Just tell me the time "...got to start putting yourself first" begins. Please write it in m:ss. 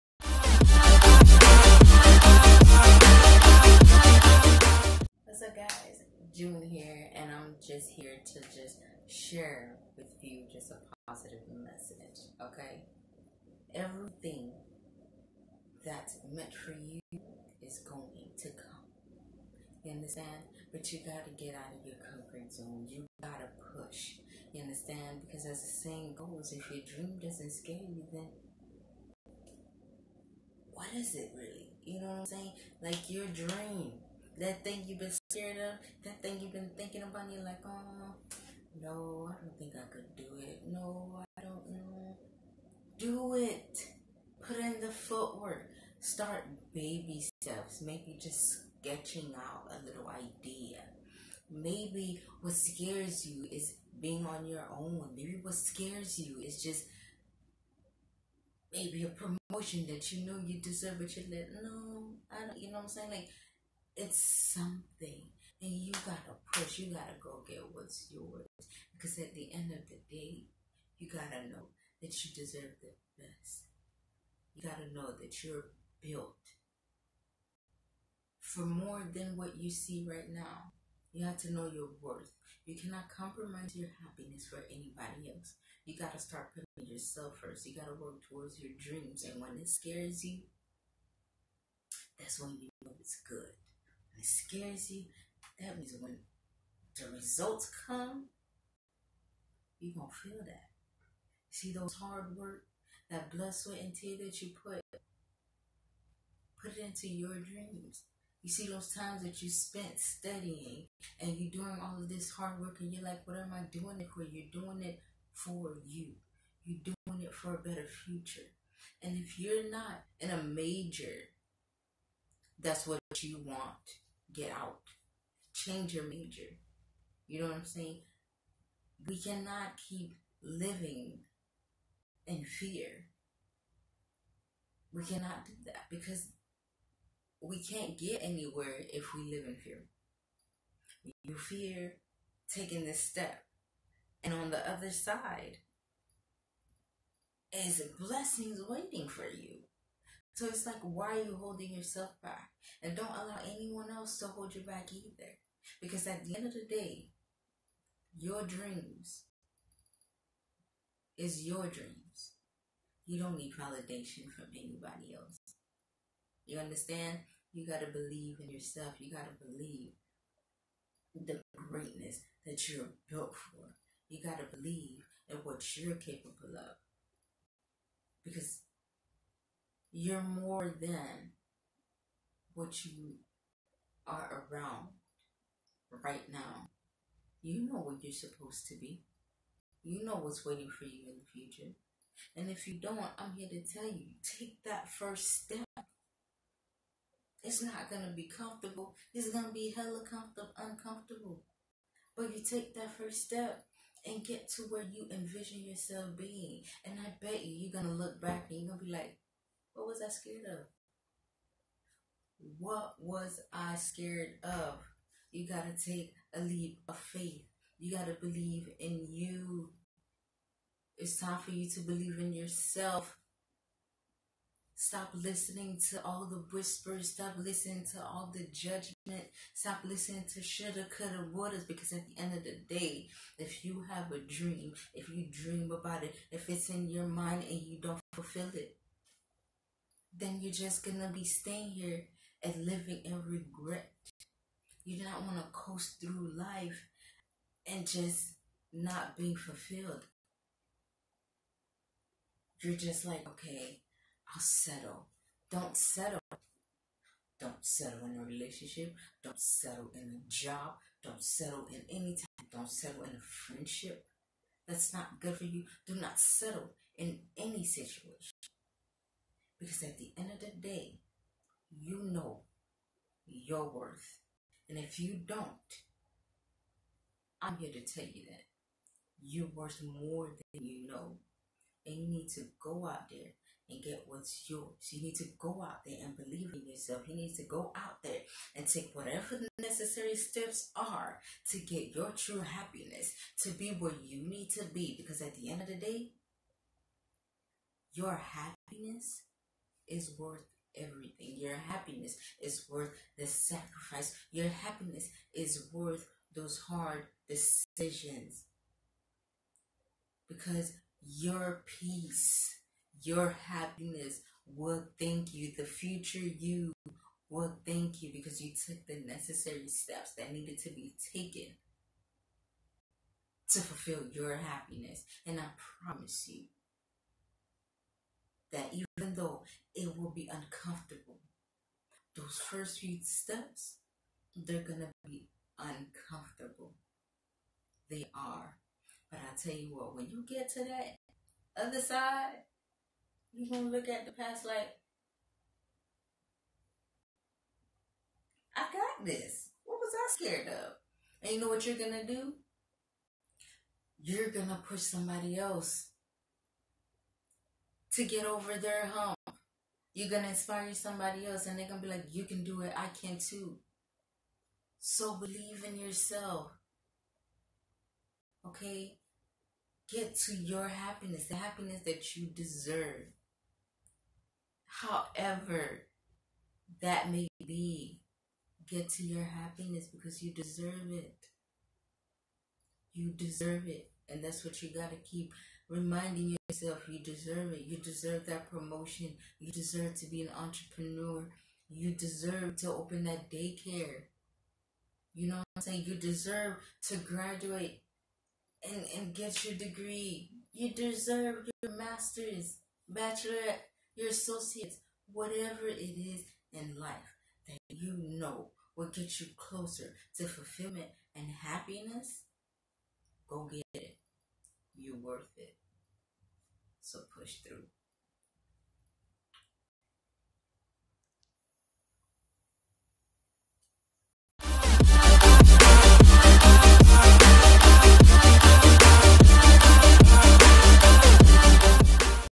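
1:25.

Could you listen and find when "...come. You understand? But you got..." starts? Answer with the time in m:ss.
0:18.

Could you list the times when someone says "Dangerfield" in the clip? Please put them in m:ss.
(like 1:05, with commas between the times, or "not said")
not said.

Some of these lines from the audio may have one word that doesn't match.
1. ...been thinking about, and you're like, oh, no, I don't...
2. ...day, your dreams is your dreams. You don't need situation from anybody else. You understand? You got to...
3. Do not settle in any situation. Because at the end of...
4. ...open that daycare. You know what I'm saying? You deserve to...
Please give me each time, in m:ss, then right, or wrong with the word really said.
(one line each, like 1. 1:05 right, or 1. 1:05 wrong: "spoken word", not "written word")
1. 0:36 right
2. 2:36 wrong: "validation", not "situation"
3. 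4:25 right
4. 6:32 right.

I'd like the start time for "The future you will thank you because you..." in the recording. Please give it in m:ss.
5:15.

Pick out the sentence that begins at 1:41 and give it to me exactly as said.
See those hard work, that blood, sweat, and tear that you put, put it into your dreams.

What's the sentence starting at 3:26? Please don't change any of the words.
And I bet you, you're going to look back and you're going to be like, what was I scared of?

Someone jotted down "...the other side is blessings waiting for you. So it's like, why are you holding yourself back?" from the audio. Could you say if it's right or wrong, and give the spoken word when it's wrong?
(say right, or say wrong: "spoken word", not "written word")
right.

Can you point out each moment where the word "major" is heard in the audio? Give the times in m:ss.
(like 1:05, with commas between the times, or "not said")
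2:00, 2:06.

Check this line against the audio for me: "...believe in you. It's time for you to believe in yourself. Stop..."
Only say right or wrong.
right.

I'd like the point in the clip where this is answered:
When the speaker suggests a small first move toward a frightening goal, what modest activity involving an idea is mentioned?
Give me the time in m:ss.
0:48.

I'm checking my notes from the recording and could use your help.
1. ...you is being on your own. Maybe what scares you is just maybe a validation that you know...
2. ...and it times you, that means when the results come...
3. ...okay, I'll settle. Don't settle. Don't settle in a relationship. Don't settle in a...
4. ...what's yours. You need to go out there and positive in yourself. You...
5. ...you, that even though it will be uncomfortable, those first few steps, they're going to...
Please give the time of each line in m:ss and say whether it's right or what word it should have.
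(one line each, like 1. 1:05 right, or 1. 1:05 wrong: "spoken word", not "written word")
1. 0:53 wrong: "promotion", not "validation"
2. 1:34 wrong: "scares", not "times"
3. 4:13 right
4. 4:44 wrong: "believe", not "positive"
5. 5:26 right.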